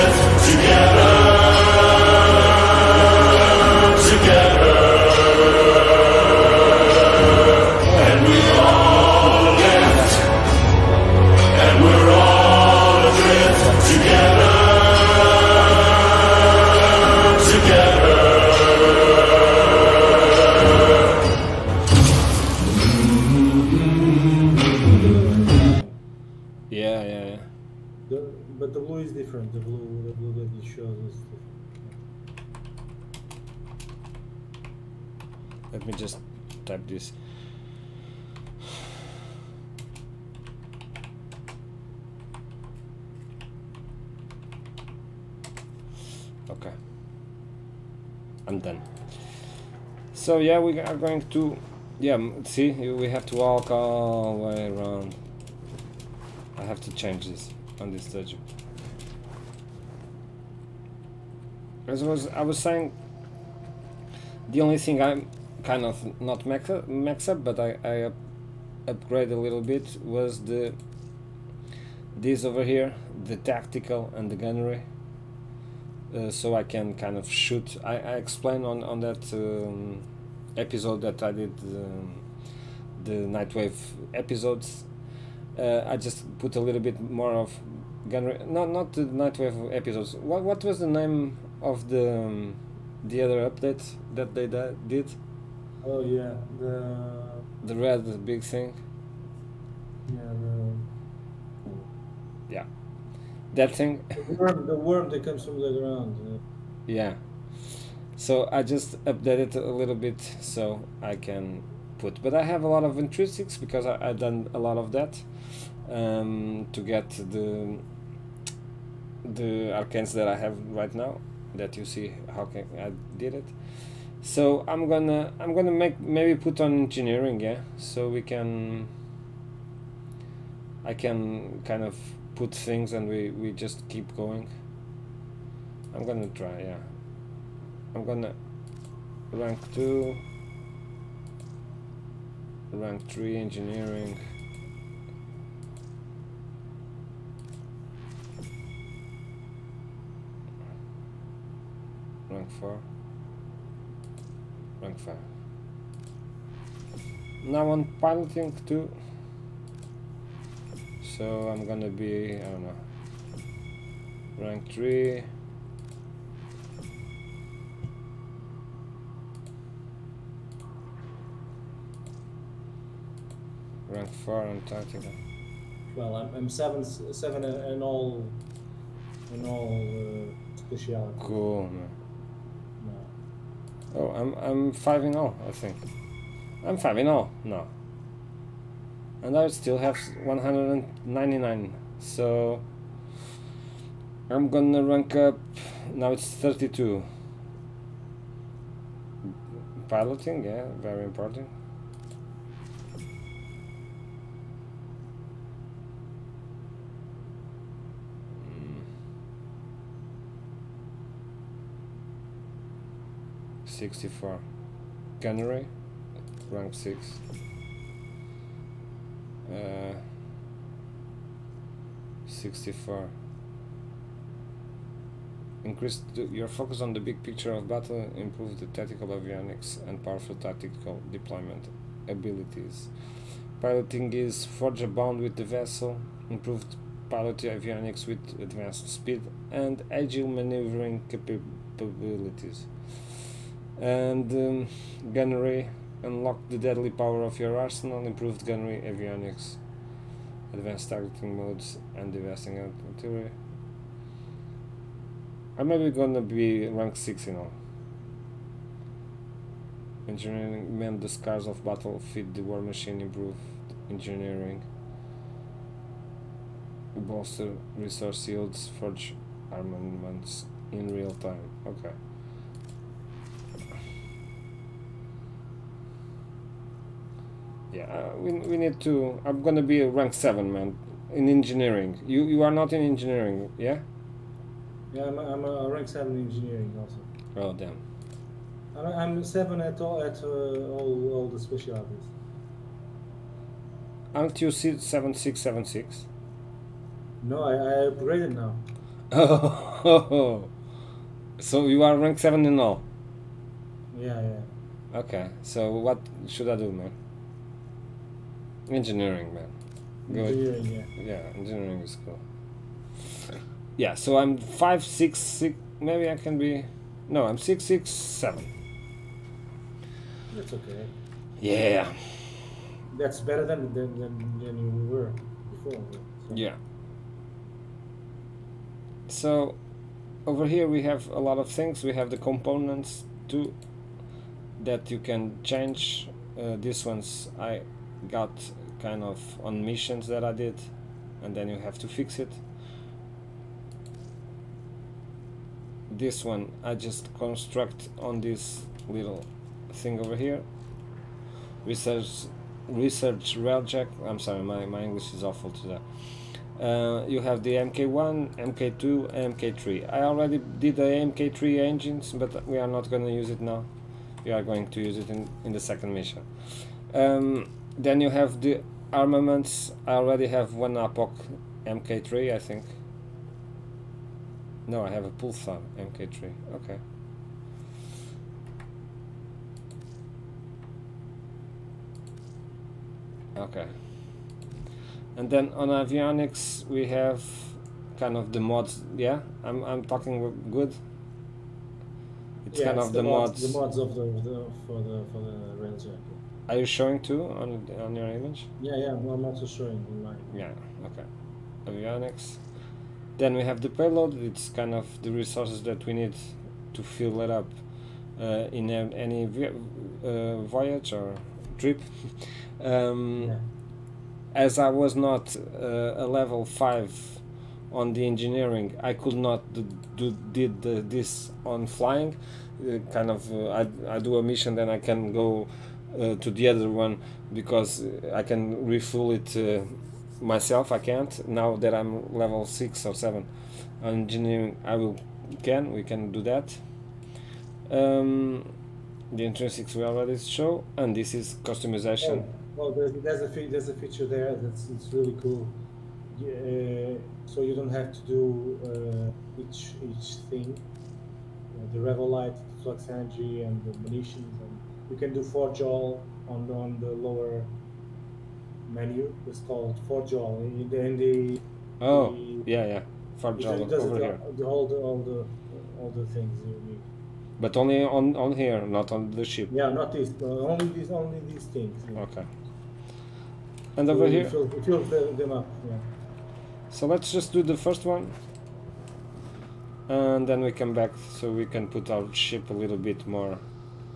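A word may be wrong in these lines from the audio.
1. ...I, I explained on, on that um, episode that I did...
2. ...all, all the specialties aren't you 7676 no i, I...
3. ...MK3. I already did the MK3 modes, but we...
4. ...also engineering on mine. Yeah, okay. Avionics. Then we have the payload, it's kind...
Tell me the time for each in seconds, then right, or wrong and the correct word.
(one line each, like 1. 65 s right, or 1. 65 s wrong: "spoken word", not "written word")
1. 77 s right
2. 290 s right
3. 359 s wrong: "engines", not "modes"
4. 399 s wrong: "showing", not "engineering".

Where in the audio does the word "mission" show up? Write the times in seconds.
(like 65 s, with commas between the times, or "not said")
339 s, 365 s, 424 s.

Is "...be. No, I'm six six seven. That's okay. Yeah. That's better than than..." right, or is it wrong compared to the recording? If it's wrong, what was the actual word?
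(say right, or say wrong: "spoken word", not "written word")
right.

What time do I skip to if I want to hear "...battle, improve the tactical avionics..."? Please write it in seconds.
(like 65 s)
227 s.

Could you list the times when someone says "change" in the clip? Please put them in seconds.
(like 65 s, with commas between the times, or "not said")
56 s, 335 s.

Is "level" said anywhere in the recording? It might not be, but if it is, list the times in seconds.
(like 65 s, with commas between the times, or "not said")
416 s, 432 s.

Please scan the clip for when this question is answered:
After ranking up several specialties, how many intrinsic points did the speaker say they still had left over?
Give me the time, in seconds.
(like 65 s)
190 s.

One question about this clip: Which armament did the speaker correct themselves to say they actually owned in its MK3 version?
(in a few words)
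Pulsar.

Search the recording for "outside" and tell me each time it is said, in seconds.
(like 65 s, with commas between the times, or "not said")
not said.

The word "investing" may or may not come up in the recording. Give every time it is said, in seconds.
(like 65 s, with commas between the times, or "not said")
252 s.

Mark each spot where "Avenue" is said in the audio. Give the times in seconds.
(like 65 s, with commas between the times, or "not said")
not said.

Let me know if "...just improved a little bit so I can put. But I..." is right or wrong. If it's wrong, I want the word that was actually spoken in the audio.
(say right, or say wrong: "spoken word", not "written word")
wrong: "updated", not "improved".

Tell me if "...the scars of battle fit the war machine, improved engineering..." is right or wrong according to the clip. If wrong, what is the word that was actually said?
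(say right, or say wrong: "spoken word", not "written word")
right.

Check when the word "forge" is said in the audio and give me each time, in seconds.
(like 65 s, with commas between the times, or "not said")
234 s, 268 s, 455 s, 463 s.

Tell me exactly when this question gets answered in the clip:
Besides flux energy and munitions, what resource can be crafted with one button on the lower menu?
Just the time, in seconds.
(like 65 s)
451 s.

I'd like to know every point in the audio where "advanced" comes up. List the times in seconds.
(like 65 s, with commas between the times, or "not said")
238 s, 250 s.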